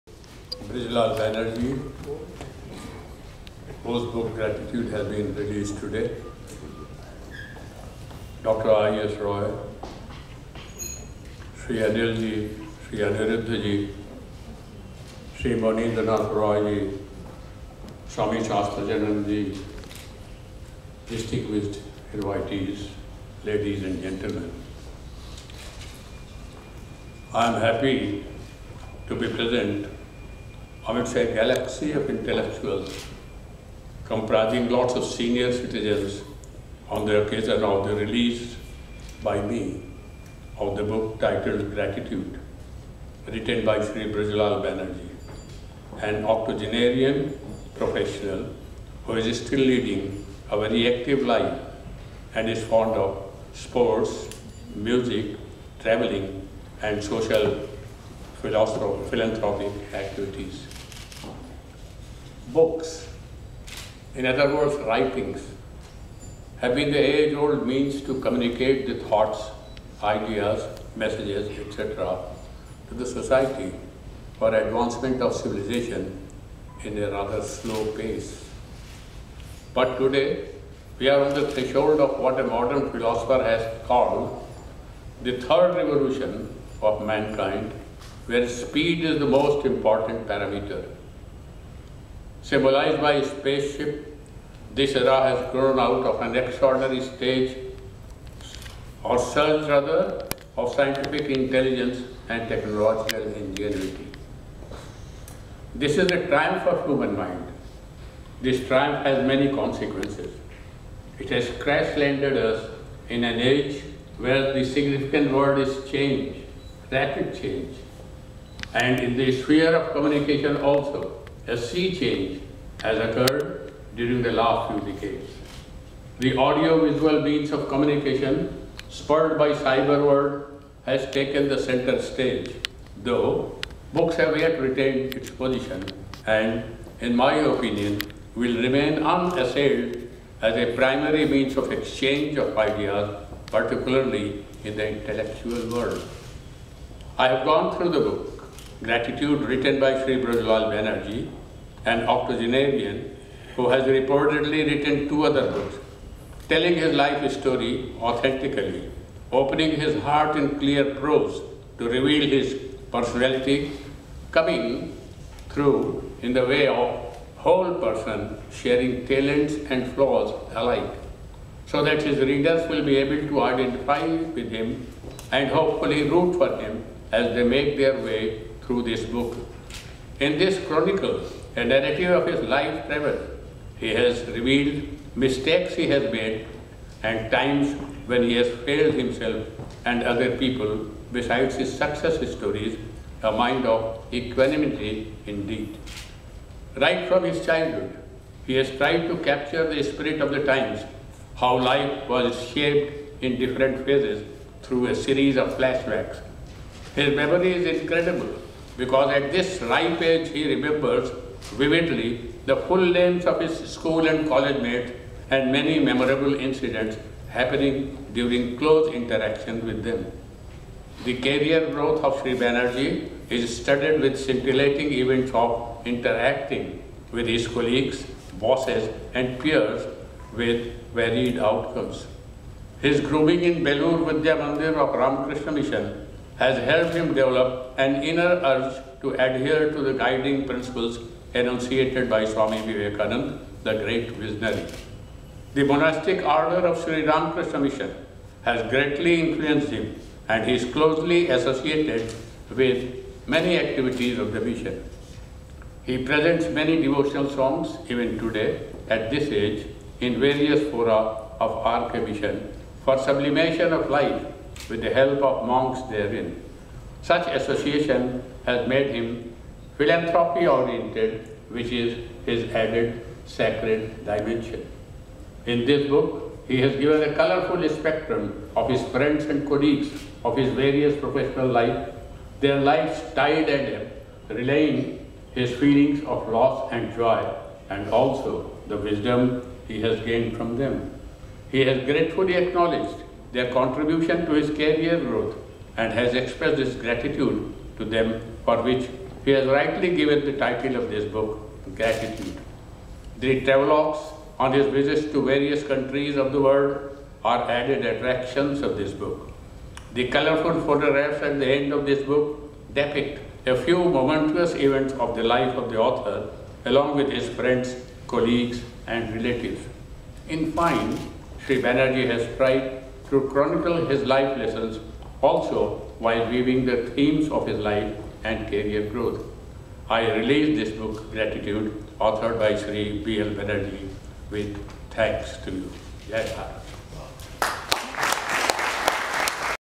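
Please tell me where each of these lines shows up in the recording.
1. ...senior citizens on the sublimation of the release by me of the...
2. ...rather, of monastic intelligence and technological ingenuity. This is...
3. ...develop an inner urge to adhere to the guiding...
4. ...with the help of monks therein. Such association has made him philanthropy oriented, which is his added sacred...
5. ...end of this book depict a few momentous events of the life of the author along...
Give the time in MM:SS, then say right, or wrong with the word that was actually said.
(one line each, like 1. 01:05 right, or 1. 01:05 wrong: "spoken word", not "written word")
1. 00:35 wrong: "occasion", not "sublimation"
2. 01:39 wrong: "scientific", not "monastic"
3. 03:57 right
4. 04:24 right
5. 05:11 right.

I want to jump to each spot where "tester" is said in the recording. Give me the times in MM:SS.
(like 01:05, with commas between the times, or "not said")
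not said.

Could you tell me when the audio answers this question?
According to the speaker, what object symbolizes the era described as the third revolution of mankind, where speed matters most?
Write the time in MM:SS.
01:33.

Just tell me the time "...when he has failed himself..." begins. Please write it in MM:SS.
03:08.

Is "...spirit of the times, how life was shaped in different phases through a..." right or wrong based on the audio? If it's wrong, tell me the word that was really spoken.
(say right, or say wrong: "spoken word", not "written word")
right.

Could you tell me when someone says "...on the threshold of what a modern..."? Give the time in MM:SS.
01:21.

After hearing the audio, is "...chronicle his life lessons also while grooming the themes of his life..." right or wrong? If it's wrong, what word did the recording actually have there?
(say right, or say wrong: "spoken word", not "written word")
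wrong: "weaving", not "grooming".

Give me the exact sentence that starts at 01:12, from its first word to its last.
to the society for advancement of civilization in a rather slow pace.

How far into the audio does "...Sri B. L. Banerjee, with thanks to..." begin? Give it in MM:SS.
05:32.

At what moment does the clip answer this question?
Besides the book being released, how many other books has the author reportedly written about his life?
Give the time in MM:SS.
02:35.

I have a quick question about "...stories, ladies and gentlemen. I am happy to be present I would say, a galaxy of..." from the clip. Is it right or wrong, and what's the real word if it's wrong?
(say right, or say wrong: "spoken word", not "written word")
wrong: "invitees", not "stories".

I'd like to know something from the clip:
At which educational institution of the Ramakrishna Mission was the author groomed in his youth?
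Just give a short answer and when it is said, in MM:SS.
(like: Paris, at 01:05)
Belur Vidya Mandir, at 03:53.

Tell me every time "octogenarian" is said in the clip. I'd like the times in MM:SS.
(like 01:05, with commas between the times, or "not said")
00:46, 02:32.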